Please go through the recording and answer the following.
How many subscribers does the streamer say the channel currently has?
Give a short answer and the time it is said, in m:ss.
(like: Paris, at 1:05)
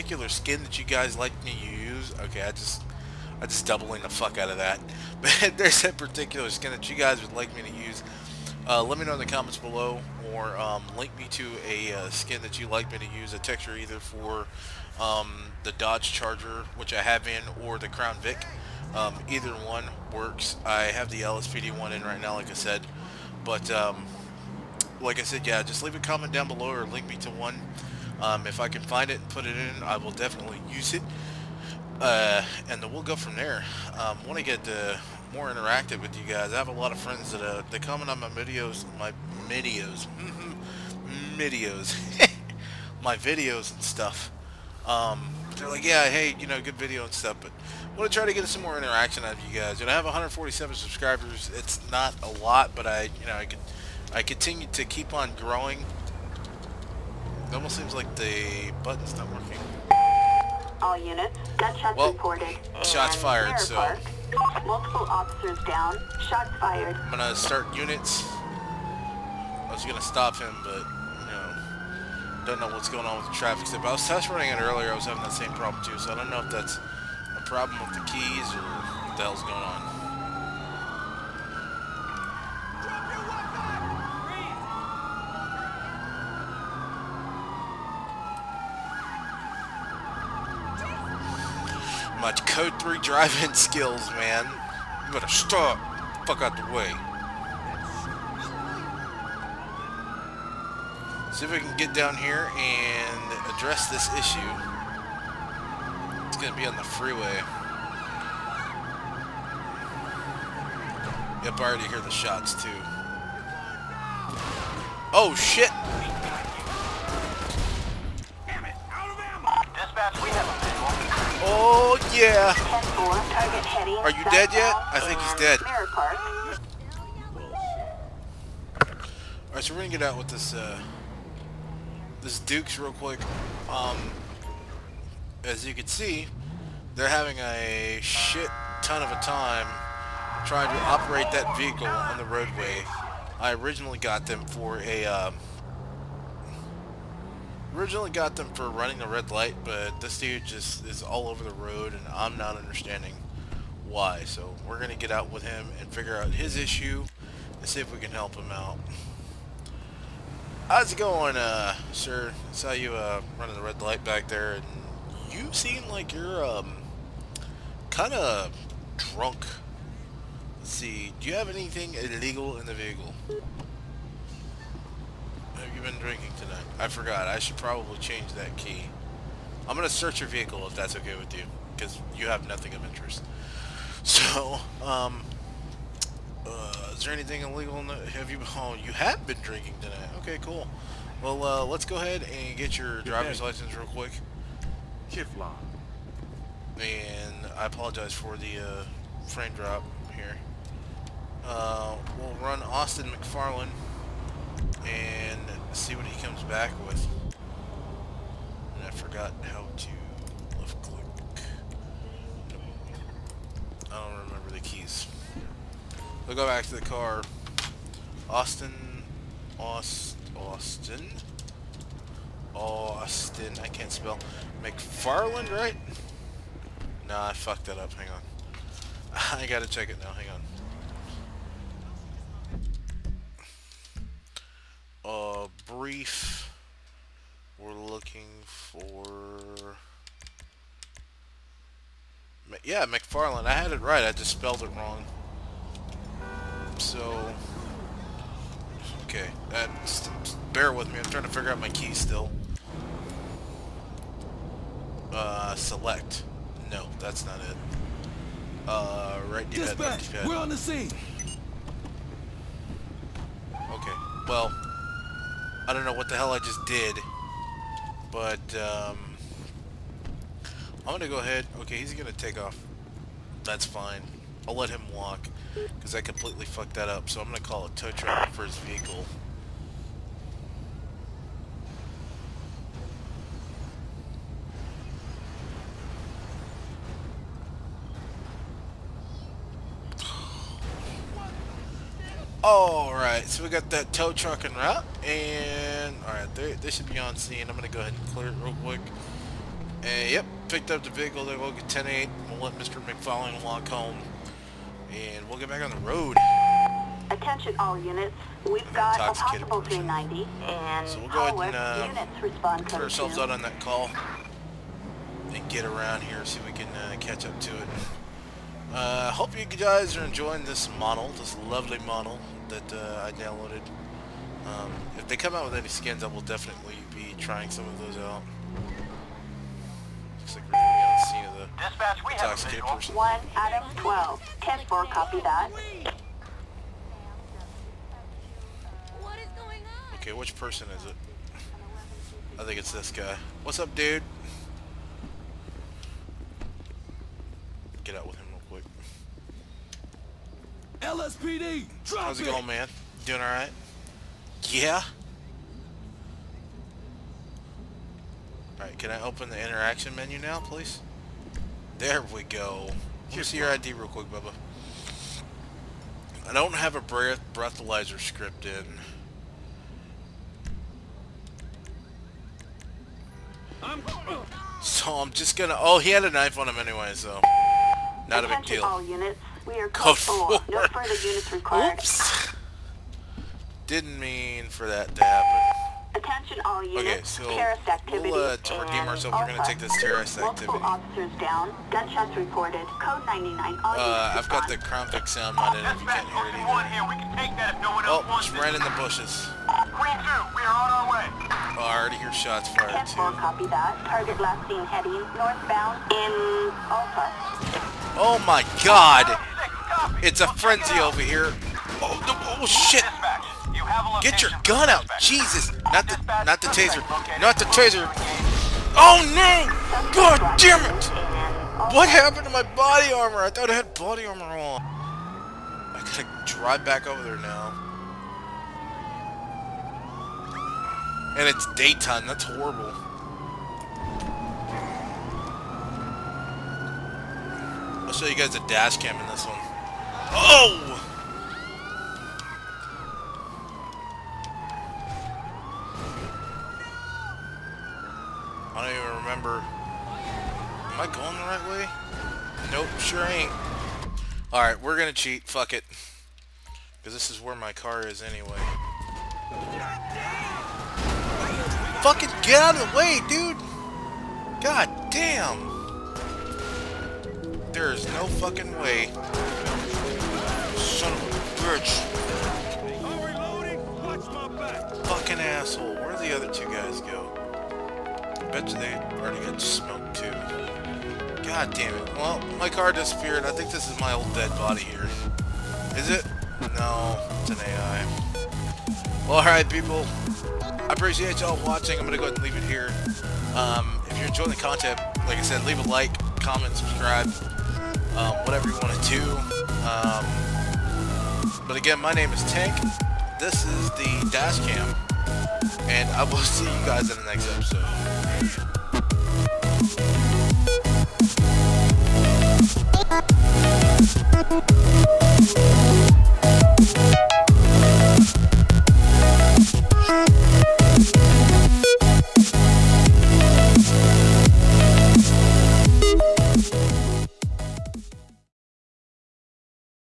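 147, at 0:50.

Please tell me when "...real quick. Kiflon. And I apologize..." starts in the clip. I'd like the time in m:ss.
3:13.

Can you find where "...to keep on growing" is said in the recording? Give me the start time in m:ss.
0:54.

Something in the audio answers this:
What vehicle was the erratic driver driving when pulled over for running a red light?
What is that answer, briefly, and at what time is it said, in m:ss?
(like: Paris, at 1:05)
Dukes, at 2:12.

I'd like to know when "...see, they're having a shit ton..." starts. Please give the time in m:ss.
2:15.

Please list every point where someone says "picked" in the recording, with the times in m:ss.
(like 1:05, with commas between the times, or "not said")
5:00.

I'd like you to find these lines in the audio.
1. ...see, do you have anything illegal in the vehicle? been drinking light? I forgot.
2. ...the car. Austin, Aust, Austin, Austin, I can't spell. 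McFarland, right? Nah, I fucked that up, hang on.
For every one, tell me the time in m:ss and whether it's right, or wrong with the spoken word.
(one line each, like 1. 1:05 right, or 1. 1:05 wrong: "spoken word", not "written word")
1. 2:50 wrong: "tonight", not "light"
2. 3:36 right.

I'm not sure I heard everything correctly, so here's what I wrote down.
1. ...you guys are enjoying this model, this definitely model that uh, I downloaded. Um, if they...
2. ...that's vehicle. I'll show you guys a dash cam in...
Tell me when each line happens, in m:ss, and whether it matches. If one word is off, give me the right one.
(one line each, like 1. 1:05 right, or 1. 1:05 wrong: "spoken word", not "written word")
1. 5:19 wrong: "lovely", not "definitely"
2. 7:12 wrong: "horrible", not "vehicle".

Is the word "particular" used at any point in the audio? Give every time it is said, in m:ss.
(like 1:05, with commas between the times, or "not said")
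0:05.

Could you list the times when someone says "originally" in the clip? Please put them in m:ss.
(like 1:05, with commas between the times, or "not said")
2:23, 2:27.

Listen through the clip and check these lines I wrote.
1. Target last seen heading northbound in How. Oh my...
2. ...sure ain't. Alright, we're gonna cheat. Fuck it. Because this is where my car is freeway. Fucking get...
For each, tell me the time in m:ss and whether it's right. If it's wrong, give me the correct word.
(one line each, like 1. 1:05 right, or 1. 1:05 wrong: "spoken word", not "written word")
1. 6:43 wrong: "Alpha", not "How"
2. 7:32 wrong: "anyway", not "freeway".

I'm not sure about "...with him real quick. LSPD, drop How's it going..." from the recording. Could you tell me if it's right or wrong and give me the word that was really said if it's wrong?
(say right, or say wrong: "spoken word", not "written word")
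right.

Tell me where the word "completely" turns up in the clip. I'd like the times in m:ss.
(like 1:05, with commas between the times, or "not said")
4:36.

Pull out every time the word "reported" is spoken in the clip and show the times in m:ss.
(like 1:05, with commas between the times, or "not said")
1:02, 6:32.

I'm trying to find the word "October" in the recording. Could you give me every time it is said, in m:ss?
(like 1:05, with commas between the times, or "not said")
not said.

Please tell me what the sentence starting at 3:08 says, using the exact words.
Oh, you have been drinking tonight.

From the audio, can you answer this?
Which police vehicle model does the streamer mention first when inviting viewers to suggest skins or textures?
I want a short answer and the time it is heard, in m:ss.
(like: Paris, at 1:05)
Dodge Charger, at 0:15.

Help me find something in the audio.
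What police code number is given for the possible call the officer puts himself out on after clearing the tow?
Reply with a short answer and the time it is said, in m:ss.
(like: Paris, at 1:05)
390, at 5:09.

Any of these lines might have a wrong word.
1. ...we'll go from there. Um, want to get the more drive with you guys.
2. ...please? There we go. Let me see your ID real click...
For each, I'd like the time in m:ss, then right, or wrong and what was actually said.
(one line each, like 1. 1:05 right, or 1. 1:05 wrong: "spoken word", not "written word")
1. 0:32 wrong: "interactive", not "drive"
2. 6:00 wrong: "quick", not "click".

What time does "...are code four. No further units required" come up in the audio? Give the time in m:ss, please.
6:19.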